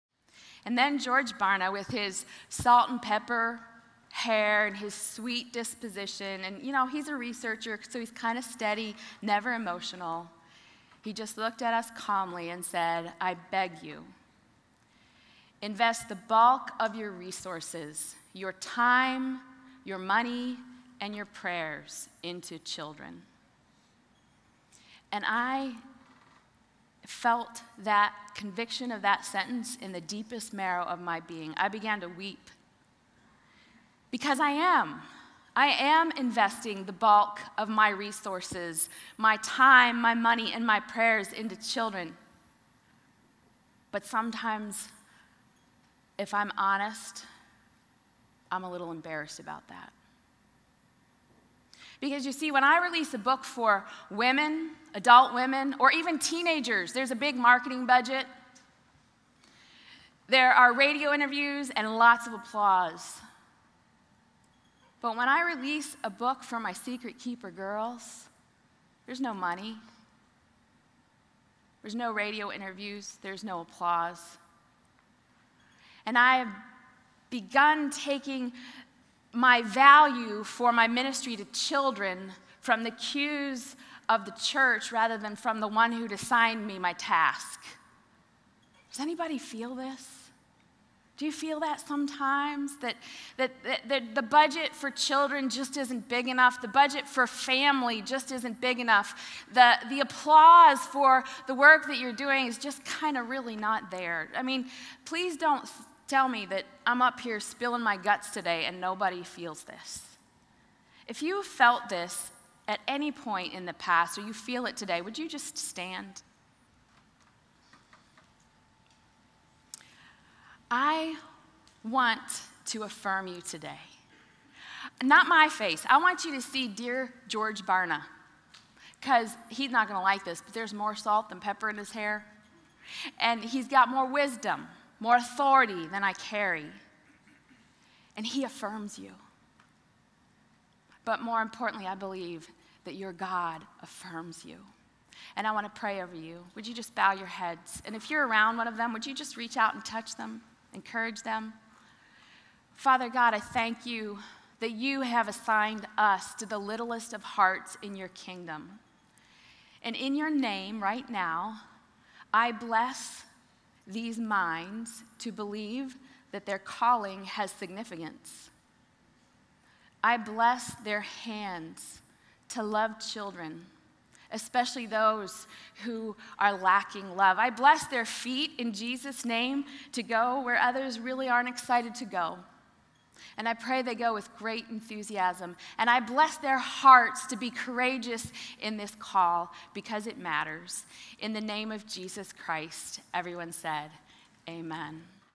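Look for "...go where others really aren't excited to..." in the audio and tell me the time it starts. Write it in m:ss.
3:00.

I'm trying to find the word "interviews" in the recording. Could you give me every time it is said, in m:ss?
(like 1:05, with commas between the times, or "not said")
1:01, 1:12.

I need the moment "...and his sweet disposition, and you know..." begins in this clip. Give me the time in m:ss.
0:04.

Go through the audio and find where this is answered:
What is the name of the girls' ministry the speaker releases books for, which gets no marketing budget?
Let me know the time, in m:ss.
1:06.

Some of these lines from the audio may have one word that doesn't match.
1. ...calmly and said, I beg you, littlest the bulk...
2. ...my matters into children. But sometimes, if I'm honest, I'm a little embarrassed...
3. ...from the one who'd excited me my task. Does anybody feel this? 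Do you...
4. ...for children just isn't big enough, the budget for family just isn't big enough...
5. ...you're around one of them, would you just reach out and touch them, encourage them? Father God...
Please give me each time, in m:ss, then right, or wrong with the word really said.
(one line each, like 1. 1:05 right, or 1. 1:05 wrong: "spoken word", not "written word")
1. 0:11 wrong: "invest", not "littlest"
2. 0:40 wrong: "prayers", not "matters"
3. 1:25 wrong: "assigned", not "excited"
4. 1:34 right
5. 2:28 right.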